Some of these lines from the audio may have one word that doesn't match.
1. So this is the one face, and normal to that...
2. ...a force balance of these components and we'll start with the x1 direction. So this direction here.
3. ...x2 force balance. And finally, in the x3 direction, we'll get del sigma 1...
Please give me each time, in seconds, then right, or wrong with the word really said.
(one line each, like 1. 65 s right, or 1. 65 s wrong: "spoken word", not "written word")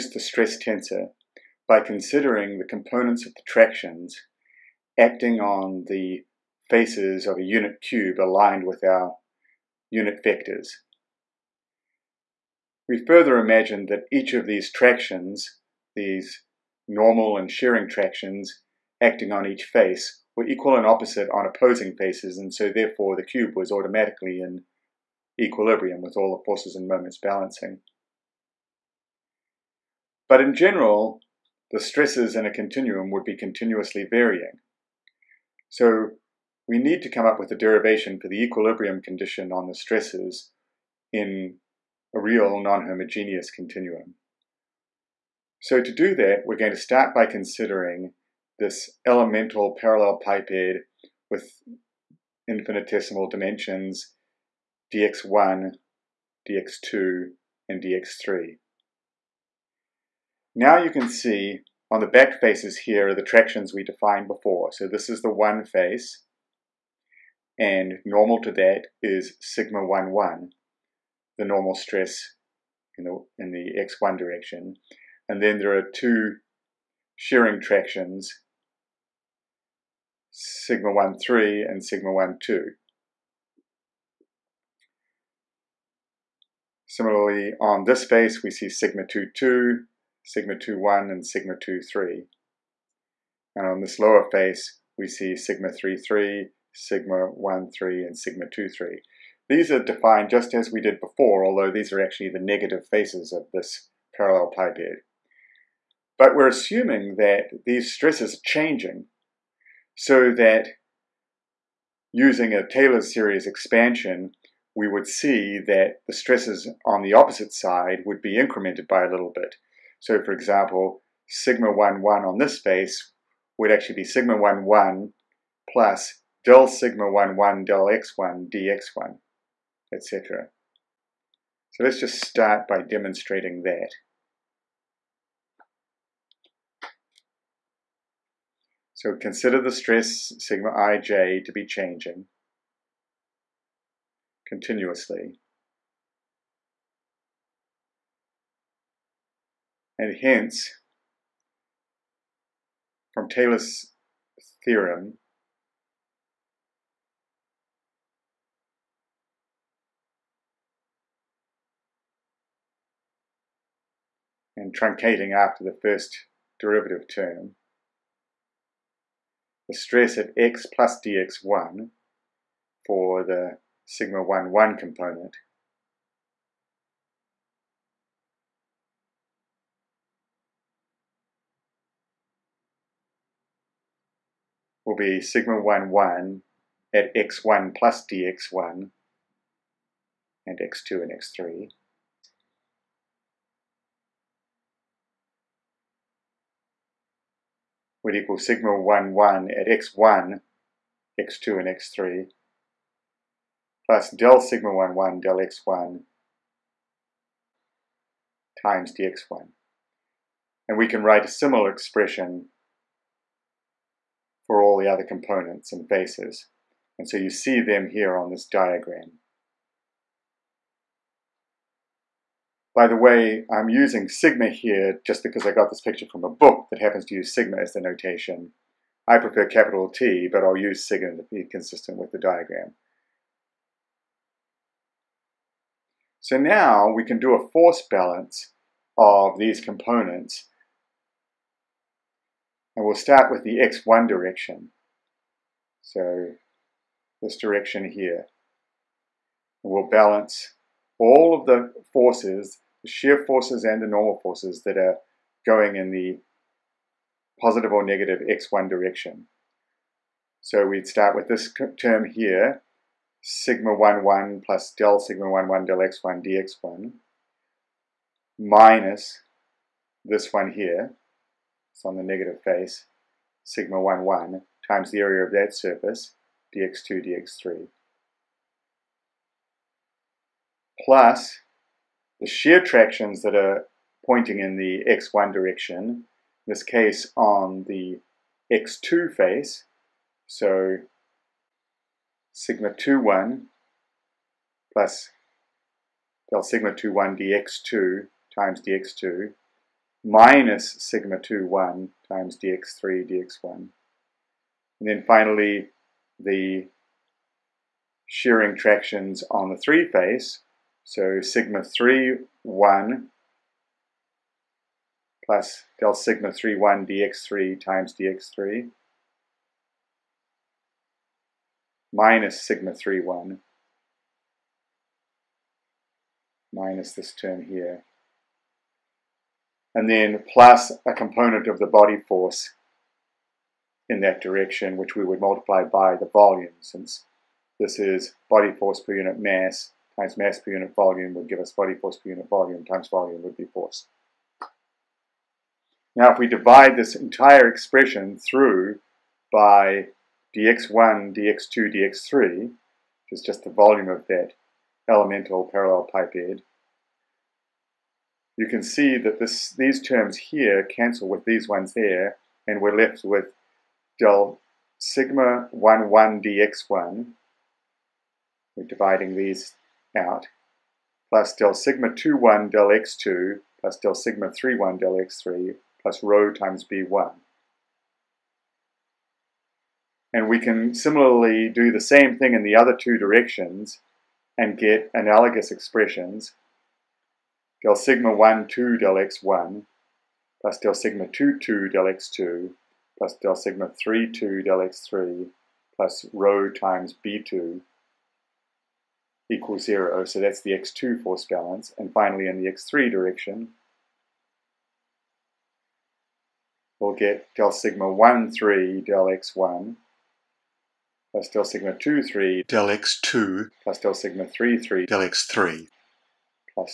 1. 64 s right
2. 237 s right
3. 400 s right.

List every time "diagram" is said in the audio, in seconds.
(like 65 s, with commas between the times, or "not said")
218 s, 232 s.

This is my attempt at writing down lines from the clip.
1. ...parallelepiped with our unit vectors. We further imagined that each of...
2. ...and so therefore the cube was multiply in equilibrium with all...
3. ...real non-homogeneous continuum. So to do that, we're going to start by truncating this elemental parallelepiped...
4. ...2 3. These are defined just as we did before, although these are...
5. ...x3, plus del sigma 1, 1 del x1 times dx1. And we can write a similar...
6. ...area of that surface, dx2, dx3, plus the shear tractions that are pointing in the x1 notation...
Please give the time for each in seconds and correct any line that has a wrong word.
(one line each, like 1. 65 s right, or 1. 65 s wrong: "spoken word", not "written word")
1. 8 s wrong: "aligned", not "parallelepiped"
2. 22 s wrong: "automatically", not "multiply"
3. 42 s wrong: "considering", not "truncating"
4. 98 s right
5. 201 s right
6. 274 s wrong: "direction", not "notation".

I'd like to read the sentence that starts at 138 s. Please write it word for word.
So consider the stress sigma ij to be changing continuously.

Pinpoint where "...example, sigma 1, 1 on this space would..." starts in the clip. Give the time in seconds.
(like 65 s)
120 s.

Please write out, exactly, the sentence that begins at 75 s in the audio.
And then there are two shearing tractions, sigma 1, 3 and sigma 1, 2.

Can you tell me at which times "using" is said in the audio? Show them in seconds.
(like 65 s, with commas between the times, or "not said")
112 s, 223 s.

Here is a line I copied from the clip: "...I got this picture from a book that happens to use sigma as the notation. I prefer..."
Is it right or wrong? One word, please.
right.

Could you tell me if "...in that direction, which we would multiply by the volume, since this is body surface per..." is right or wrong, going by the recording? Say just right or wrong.
wrong.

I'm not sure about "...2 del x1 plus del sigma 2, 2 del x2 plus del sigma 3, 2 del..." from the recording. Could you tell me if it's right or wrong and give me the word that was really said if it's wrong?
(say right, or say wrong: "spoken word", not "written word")
right.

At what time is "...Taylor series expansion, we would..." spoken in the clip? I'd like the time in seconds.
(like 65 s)
112 s.